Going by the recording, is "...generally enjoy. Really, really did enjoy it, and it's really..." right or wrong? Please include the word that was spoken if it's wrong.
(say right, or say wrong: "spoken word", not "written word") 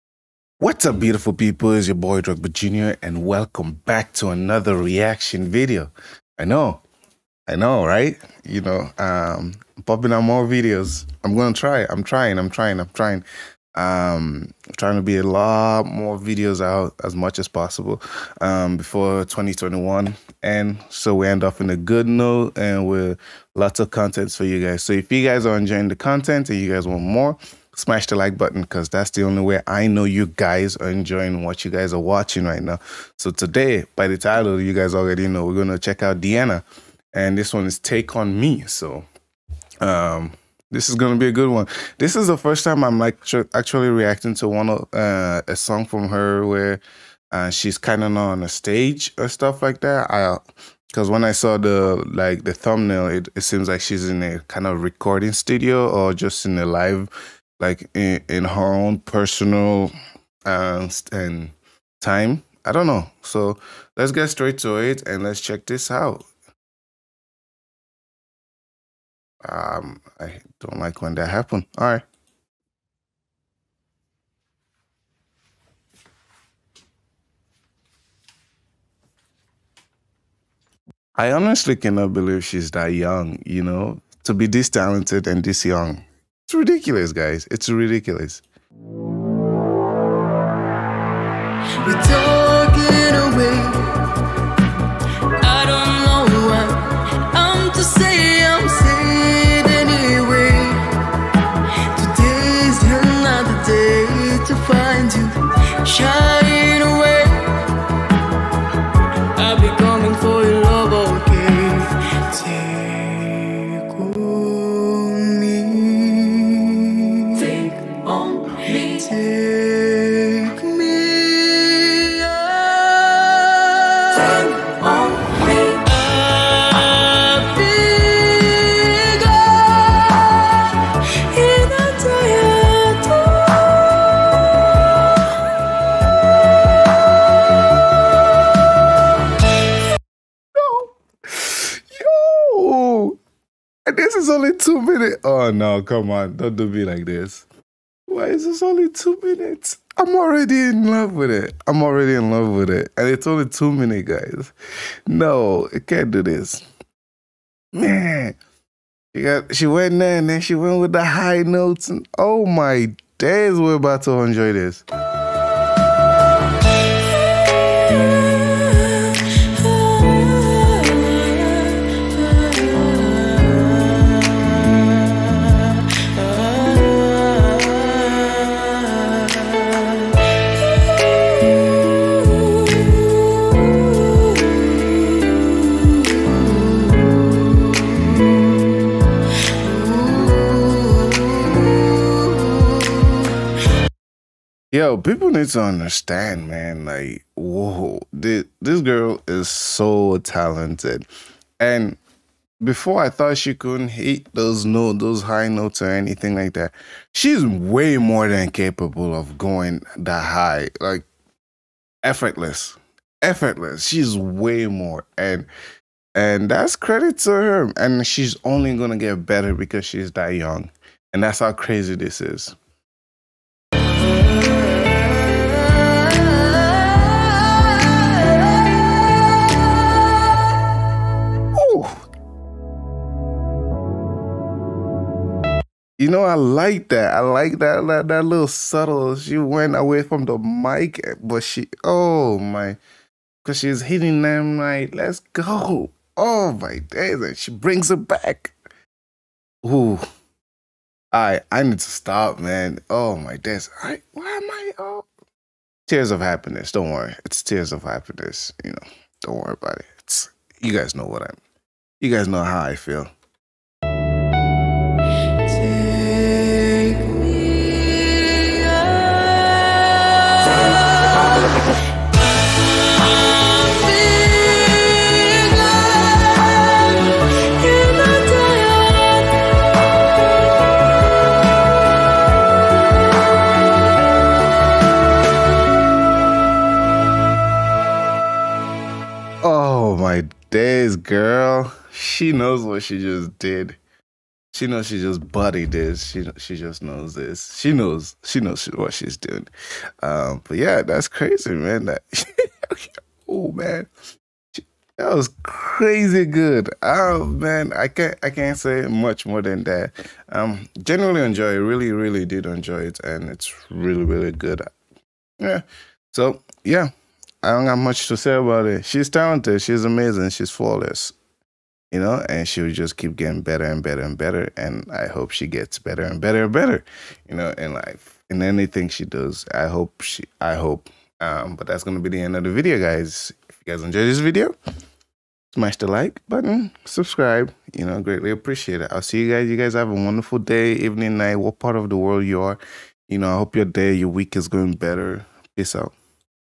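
right.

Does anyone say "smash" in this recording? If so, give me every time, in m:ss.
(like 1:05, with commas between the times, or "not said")
0:27, 5:35.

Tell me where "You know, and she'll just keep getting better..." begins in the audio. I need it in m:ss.
5:21.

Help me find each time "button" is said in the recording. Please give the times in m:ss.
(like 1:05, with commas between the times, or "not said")
0:28, 5:36.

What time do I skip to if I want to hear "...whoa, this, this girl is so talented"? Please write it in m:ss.
3:17.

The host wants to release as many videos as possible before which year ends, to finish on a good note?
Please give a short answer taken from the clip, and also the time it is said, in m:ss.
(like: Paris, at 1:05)
2021, at 0:19.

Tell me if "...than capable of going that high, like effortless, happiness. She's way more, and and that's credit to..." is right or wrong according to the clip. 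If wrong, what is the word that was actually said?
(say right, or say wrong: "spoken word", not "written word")
wrong: "effortless", not "happiness".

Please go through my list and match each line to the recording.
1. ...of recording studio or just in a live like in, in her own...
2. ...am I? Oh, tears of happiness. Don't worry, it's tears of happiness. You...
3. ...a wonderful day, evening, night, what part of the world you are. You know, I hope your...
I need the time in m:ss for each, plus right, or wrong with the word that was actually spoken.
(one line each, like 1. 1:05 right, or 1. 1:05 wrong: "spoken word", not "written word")
1. 0:54 right
2. 4:14 right
3. 5:39 right.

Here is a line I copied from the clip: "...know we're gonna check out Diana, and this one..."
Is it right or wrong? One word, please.
right.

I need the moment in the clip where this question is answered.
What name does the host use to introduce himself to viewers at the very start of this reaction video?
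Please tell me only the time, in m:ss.
0:02.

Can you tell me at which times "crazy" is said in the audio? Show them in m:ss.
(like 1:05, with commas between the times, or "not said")
3:41, 5:01, 5:05.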